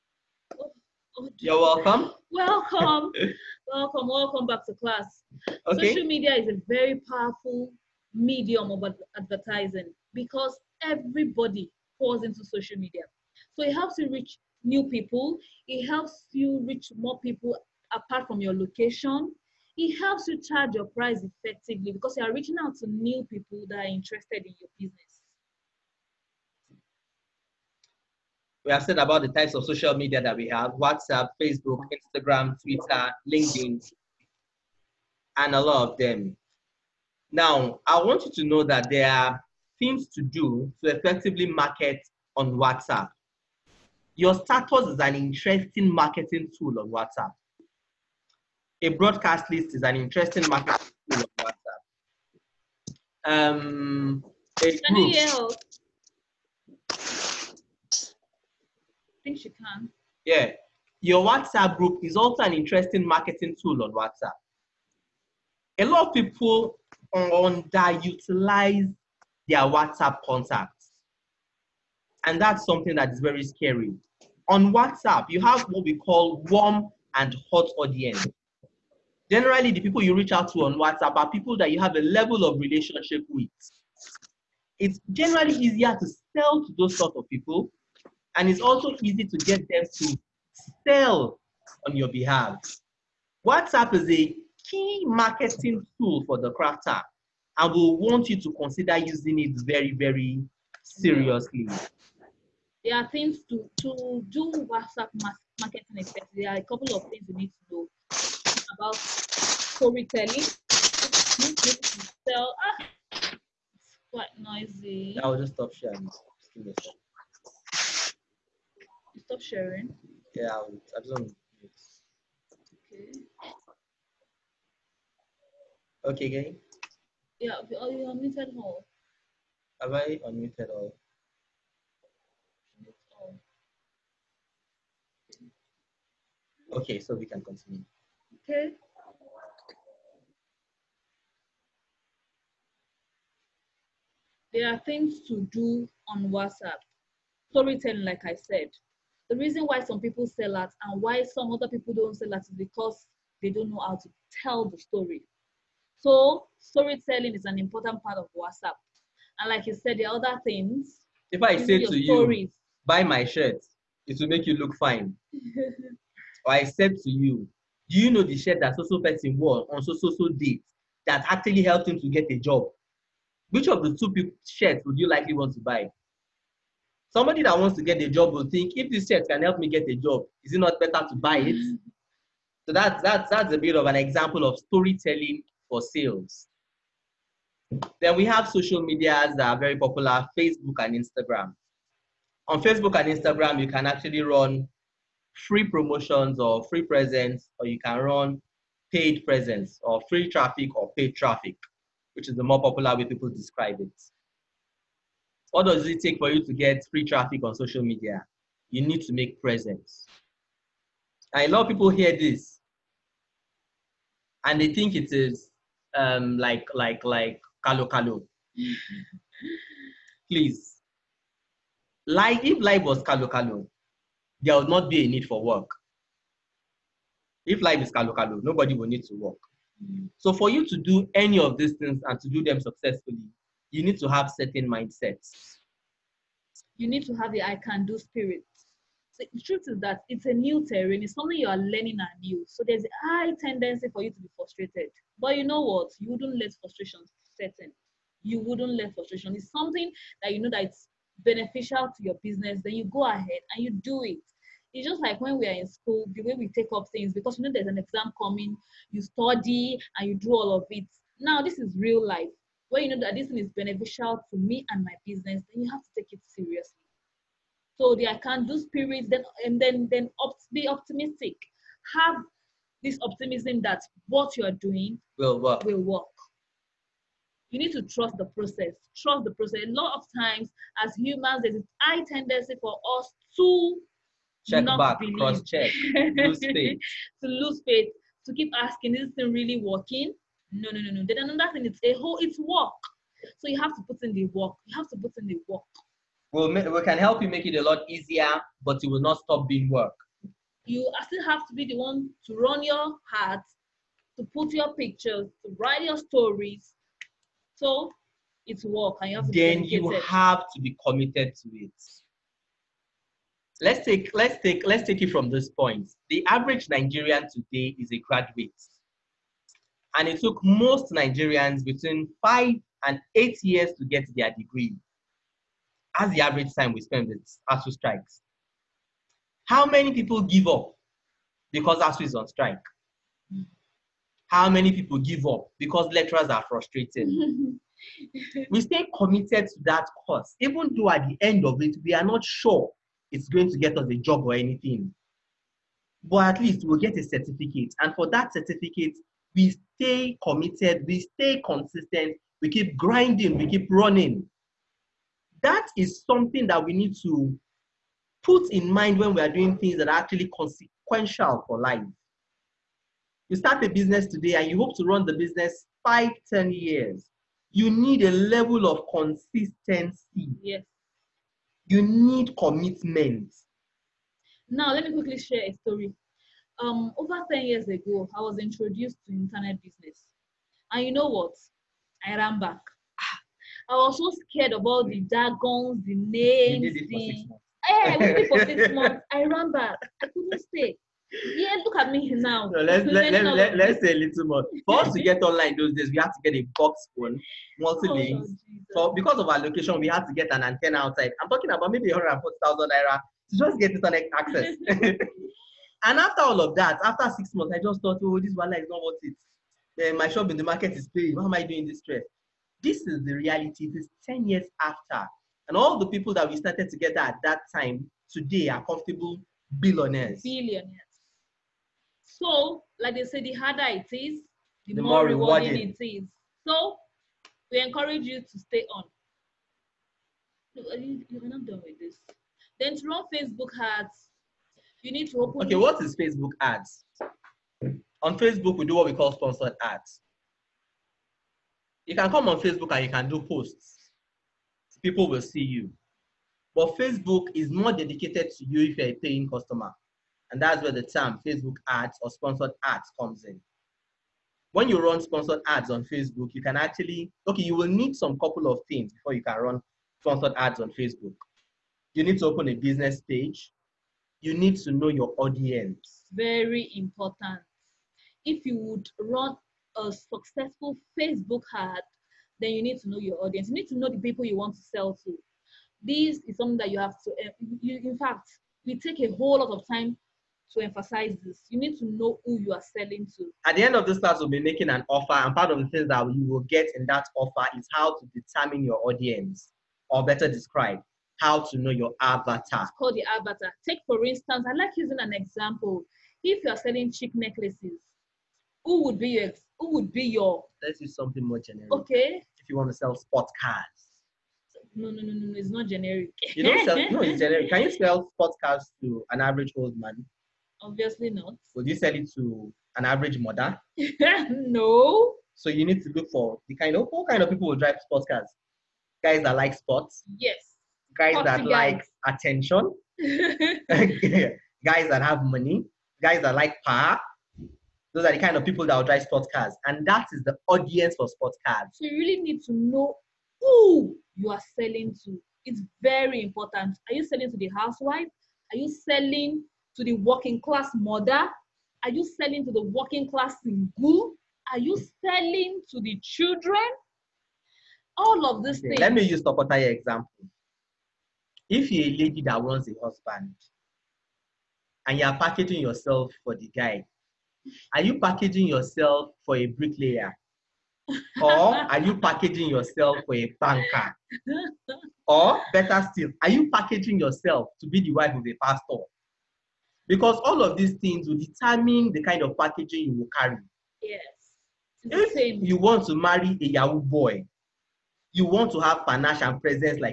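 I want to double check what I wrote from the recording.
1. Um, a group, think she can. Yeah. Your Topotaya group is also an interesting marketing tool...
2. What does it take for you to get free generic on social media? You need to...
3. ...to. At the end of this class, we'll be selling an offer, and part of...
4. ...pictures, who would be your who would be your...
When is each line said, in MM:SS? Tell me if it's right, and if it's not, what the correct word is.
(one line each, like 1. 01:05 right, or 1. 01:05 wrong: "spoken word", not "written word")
1. 00:53 wrong: "WhatsApp", not "Topotaya"
2. 03:25 wrong: "traffic", not "generic"
3. 08:03 wrong: "making", not "selling"
4. 08:17 wrong: "necklaces", not "pictures".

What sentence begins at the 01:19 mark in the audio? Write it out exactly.
Generally, the people you reach out to on WhatsApp are people that you have a level of relationship with.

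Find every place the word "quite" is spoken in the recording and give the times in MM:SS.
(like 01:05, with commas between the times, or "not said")
01:54.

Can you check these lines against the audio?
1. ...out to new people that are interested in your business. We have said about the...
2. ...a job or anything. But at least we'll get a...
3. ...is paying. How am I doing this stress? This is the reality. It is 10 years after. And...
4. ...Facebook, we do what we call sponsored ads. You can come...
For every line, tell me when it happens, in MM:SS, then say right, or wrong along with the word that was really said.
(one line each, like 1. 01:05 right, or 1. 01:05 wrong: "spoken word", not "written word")
1. 00:22 right
2. 05:43 right
3. 06:50 right
4. 07:18 right.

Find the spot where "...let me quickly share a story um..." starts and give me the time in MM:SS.
06:14.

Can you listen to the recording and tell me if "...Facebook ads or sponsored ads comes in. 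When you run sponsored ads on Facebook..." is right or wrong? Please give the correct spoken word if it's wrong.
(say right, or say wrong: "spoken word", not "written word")
right.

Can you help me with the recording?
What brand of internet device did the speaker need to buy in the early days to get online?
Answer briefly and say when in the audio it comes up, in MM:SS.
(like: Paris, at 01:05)
Multi links, at 06:37.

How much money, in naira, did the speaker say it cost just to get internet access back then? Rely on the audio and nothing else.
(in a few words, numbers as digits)
140,000 naira.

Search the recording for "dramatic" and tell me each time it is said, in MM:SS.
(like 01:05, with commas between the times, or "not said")
not said.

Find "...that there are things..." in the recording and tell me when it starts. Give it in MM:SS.
00:38.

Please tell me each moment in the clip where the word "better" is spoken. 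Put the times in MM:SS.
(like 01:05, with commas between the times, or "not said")
03:00, 08:10, 09:25.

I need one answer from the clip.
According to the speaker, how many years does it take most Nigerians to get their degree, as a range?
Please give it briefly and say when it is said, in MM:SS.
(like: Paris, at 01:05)
5 to 8 years, at 05:21.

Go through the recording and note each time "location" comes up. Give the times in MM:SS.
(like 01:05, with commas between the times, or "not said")
00:18, 06:39.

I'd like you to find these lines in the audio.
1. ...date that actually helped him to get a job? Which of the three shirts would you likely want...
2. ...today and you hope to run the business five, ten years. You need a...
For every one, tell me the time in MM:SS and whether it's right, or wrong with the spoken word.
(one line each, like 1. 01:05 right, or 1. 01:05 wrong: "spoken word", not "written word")
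1. 02:50 wrong: "two", not "three"
2. 06:04 right.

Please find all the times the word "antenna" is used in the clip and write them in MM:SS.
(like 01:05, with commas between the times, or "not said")
06:40.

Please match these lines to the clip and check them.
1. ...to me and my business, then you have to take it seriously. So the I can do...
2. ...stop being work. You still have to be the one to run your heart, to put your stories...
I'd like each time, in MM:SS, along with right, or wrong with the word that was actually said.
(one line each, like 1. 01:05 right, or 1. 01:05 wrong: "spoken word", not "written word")
1. 04:24 right
2. 04:59 wrong: "pictures", not "stories".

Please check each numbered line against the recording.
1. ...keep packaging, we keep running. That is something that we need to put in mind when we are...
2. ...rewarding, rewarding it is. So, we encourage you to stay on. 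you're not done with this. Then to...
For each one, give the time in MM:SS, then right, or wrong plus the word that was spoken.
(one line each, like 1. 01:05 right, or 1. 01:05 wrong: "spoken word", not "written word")
1. 05:52 wrong: "grinding", not "packaging"
2. 07:05 right.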